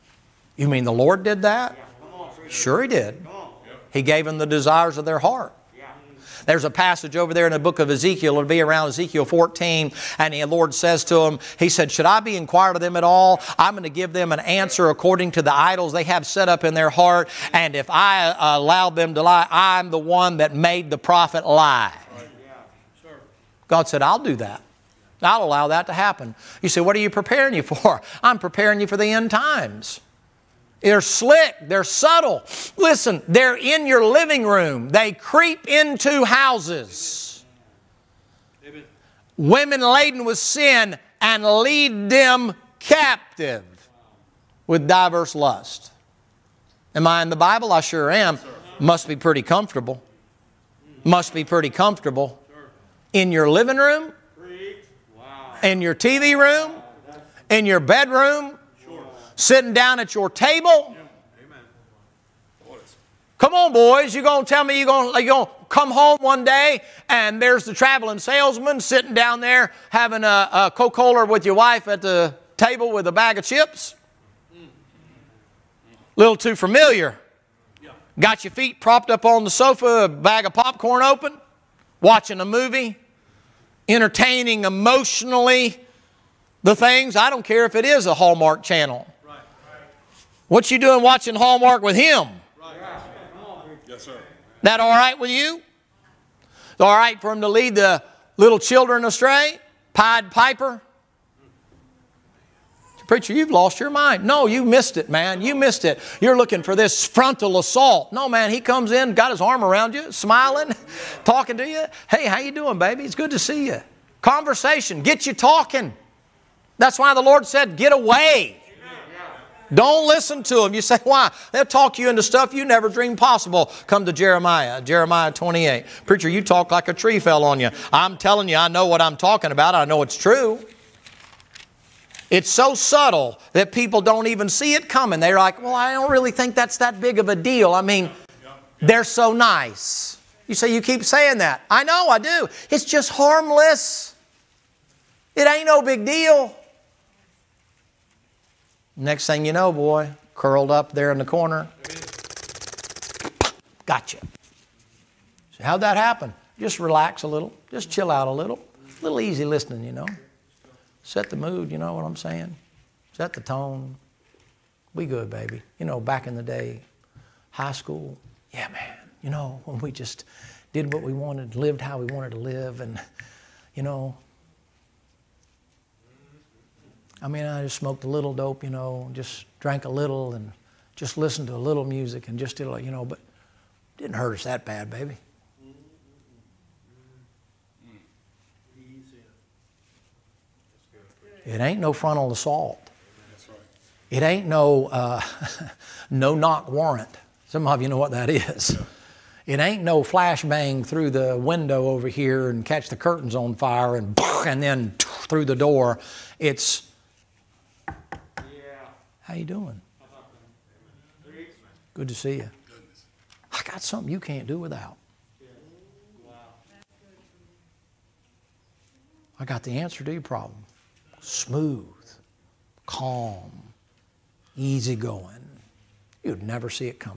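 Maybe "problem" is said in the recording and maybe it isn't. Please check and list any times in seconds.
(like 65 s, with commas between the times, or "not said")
220 s.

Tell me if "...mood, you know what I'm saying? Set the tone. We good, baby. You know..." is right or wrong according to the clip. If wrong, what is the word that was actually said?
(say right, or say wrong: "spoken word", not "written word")
right.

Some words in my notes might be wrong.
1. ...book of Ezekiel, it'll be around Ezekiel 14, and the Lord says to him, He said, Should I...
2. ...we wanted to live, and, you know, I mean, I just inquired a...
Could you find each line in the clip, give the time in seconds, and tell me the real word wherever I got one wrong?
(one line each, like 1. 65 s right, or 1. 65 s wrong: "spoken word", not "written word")
1. 7 s right
2. 171 s wrong: "smoked", not "inquired".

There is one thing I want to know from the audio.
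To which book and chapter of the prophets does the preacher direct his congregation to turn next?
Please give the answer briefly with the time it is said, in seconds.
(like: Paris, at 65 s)
Jeremiah 28, at 124 s.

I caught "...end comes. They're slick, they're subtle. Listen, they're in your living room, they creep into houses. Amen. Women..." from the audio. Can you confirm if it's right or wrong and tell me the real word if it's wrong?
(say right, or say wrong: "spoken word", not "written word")
wrong: "times", not "comes".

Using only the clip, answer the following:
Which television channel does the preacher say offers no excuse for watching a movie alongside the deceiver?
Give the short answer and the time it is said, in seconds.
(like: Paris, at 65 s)
Hallmark channel, at 88 s.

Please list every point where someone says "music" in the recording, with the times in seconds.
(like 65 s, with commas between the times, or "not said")
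181 s.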